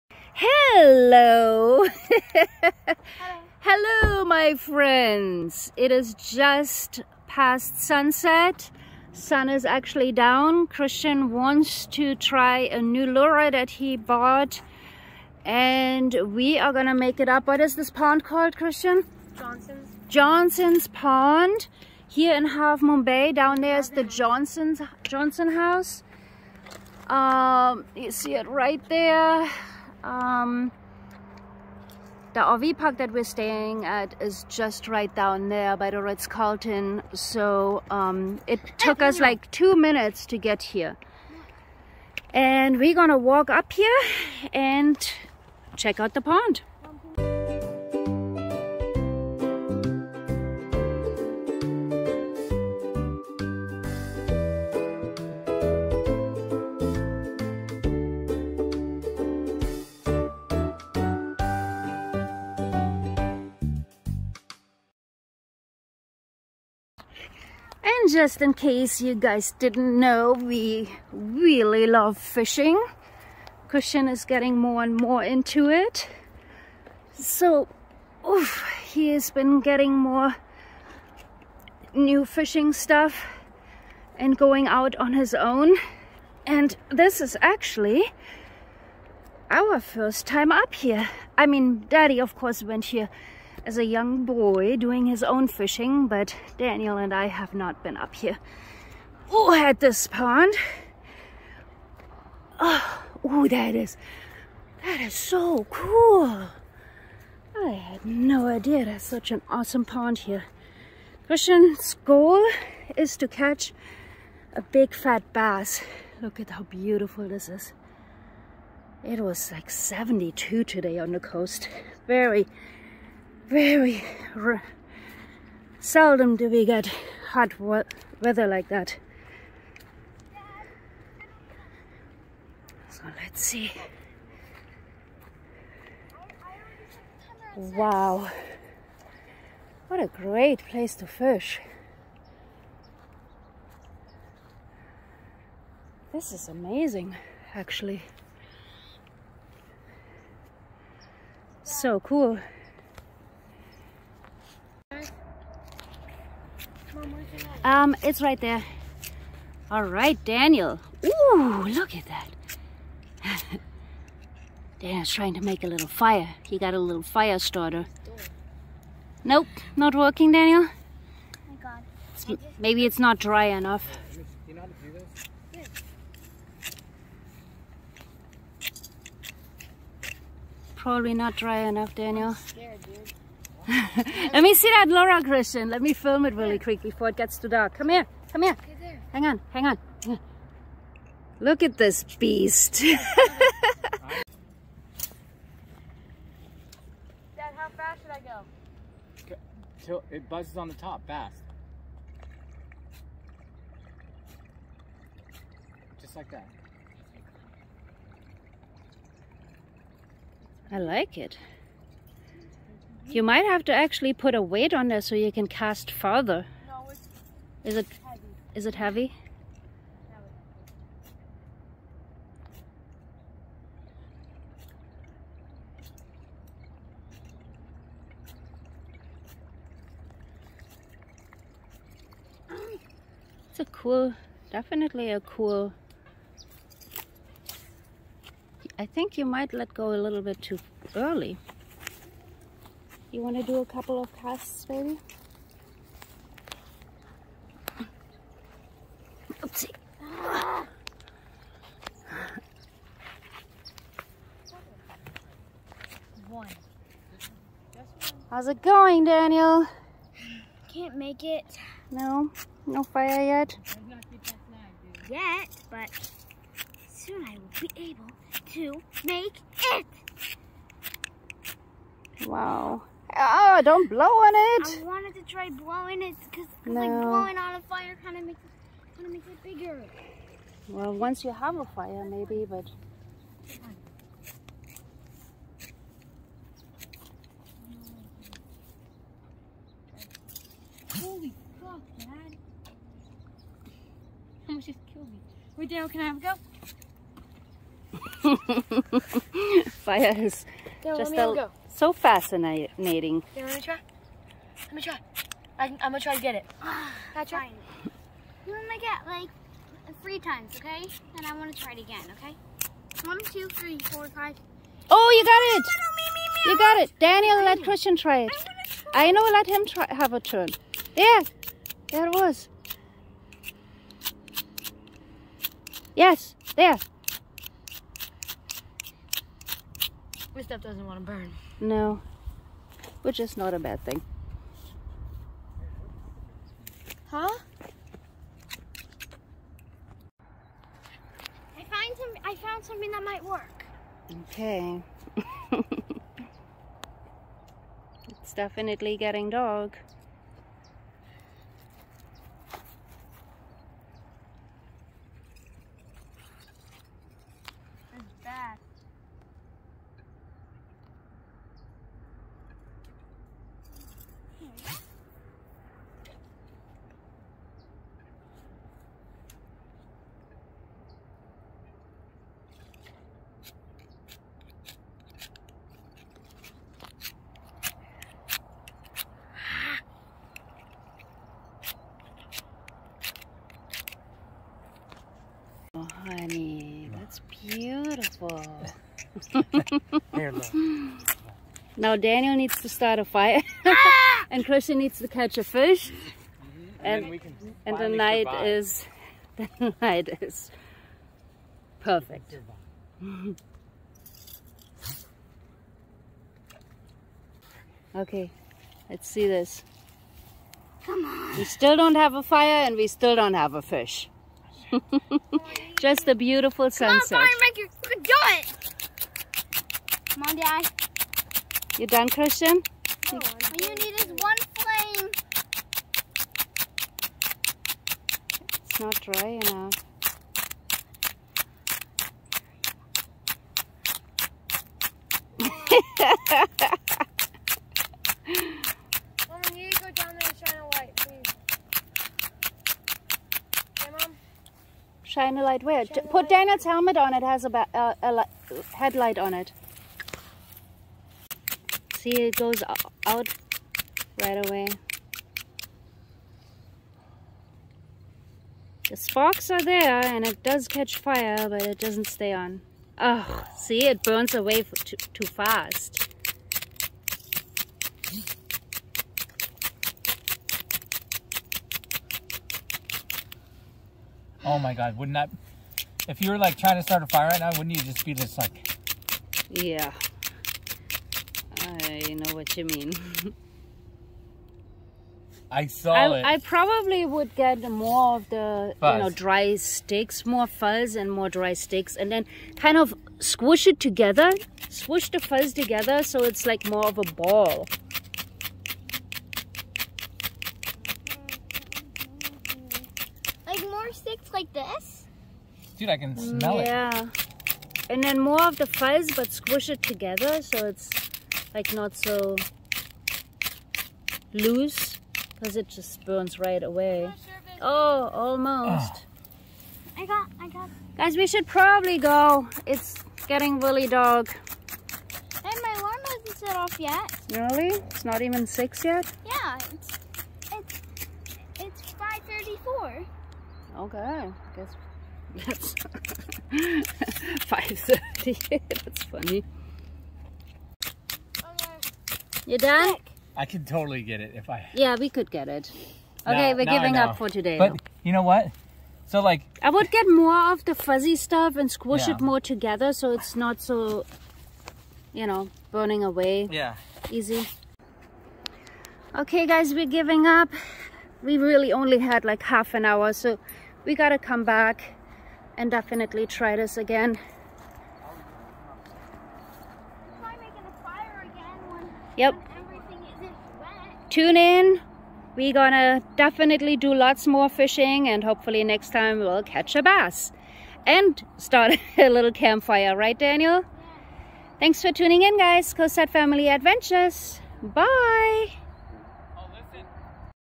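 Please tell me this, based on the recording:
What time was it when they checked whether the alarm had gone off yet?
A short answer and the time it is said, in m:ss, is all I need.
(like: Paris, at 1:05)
5:34, at 8:51.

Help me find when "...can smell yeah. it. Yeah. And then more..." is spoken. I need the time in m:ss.
8:25.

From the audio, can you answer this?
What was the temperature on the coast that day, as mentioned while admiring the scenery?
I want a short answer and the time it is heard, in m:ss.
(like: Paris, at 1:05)
72, at 1:59.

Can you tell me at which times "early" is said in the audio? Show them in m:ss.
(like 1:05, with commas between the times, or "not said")
4:00.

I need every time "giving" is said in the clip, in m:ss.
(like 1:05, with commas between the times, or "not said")
9:06, 9:19.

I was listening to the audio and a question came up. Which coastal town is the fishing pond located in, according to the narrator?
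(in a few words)
Half Moon Bay.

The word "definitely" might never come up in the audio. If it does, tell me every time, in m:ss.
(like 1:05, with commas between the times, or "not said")
3:54, 5:48, 9:25, 9:36.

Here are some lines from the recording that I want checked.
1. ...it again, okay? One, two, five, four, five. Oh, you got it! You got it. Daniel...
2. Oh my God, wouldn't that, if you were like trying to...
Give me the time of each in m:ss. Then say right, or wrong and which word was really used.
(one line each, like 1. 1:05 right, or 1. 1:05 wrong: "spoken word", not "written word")
1. 5:11 wrong: "three", not "five"
2. 7:54 right.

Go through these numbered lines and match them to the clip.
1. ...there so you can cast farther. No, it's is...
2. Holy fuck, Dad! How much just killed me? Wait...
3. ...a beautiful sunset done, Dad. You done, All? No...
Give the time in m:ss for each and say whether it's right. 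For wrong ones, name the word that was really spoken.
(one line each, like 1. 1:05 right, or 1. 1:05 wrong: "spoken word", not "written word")
1. 3:34 right
2. 4:50 right
3. 6:56 wrong: "Christian", not "All".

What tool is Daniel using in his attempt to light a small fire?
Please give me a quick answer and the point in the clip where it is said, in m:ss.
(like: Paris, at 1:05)
fire starter, at 2:47.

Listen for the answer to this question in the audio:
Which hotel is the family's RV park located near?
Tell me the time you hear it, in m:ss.
0:36.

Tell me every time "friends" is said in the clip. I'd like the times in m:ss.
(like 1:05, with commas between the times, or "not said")
0:04.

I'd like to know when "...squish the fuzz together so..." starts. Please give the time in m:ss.
8:14.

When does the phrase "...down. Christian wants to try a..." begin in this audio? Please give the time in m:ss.
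0:10.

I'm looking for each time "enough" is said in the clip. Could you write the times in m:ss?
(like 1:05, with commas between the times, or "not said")
2:53, 3:01, 7:09.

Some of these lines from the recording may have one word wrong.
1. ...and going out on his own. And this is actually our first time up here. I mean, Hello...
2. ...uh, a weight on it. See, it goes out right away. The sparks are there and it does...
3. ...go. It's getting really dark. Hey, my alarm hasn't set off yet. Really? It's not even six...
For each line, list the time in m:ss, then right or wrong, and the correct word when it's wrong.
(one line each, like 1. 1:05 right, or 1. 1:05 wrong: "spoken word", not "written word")
1. 1:24 wrong: "Daddy", not "Hello"
2. 7:27 wrong: "headlight", not "weight"
3. 8:41 right.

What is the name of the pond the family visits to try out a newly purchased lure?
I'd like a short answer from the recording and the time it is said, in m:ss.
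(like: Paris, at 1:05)
Johnson's Pond, at 0:20.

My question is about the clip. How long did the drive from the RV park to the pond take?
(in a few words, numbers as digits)
2 minutes.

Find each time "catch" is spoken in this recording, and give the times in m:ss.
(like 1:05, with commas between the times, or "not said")
1:53, 6:35, 7:40, 9:39.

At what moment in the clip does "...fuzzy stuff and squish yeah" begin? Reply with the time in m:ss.
9:10.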